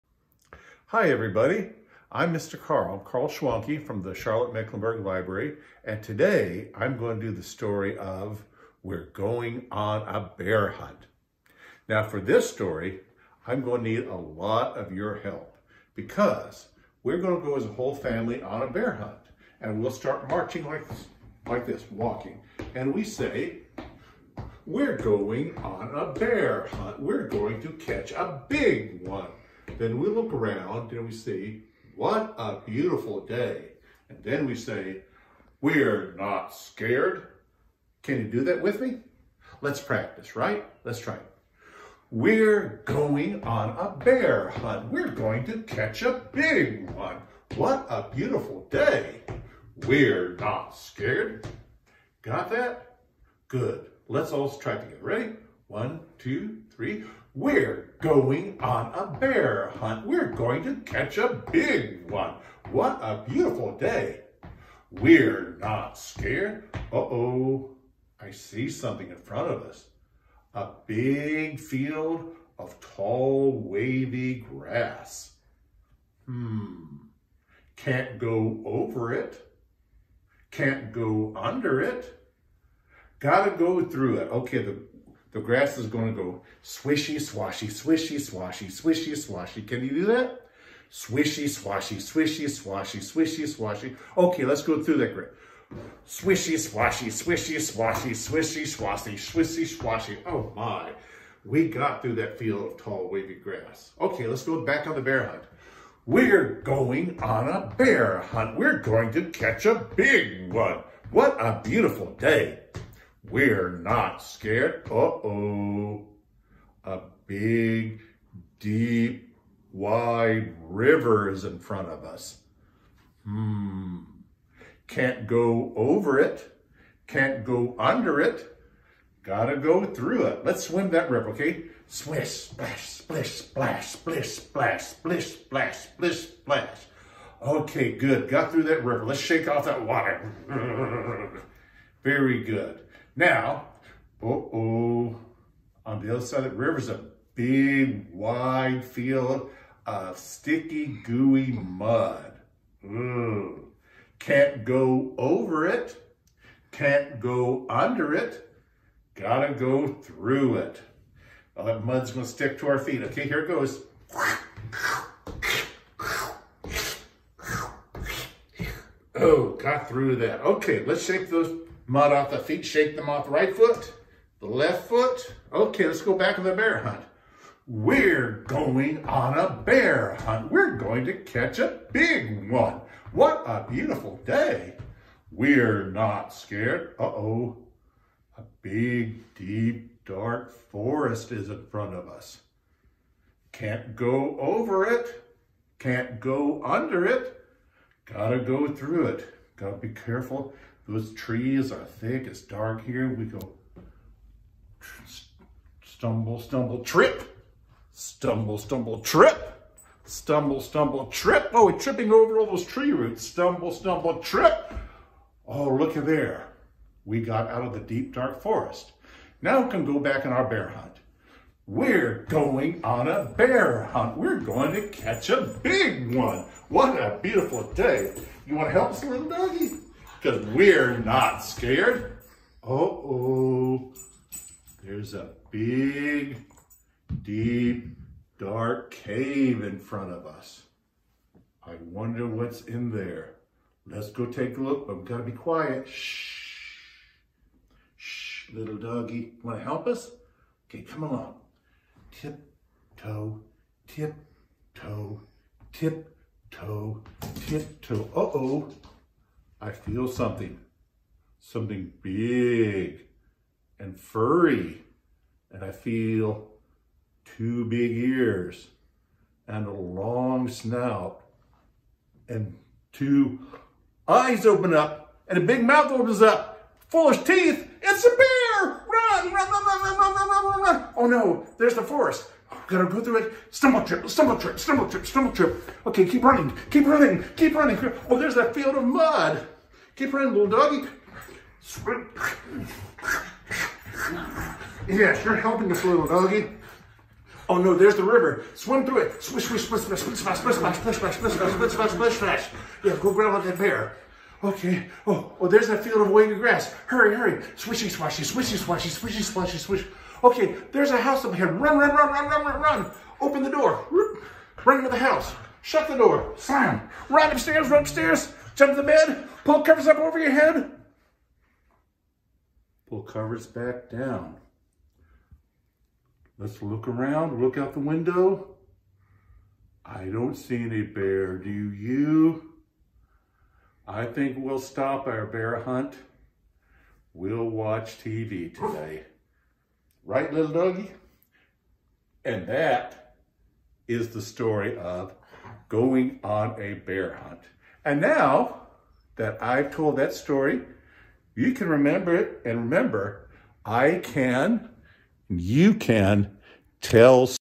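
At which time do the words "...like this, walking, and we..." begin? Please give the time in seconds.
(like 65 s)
21 s.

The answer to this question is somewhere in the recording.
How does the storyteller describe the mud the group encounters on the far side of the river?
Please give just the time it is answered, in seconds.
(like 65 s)
150 s.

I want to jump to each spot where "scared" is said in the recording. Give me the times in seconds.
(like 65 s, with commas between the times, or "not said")
36 s, 50 s, 65 s, 114 s, 186 s, 231 s.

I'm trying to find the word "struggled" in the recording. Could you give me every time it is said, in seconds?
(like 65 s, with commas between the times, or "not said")
not said.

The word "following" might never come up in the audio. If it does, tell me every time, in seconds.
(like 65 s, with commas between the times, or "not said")
not said.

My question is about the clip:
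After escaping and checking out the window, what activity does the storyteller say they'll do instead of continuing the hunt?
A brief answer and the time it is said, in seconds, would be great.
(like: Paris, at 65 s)
Watch TV, at 337 s.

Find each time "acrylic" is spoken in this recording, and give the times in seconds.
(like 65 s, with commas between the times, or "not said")
not said.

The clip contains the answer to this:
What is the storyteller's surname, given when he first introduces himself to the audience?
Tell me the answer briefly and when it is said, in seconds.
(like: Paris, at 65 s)
Schwanke, at 3 s.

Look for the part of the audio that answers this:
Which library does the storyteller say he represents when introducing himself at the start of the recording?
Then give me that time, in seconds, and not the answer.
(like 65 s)
4 s.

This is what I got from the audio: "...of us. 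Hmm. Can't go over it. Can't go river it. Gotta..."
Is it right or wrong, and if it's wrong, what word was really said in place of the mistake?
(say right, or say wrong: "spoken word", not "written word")
wrong: "under", not "river".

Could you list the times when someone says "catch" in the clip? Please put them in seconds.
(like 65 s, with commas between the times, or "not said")
27 s, 45 s, 60 s, 109 s, 181 s, 224 s.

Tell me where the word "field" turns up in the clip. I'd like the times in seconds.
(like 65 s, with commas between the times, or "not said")
71 s, 102 s, 148 s, 288 s, 305 s.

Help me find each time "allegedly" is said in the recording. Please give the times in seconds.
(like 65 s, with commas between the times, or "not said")
not said.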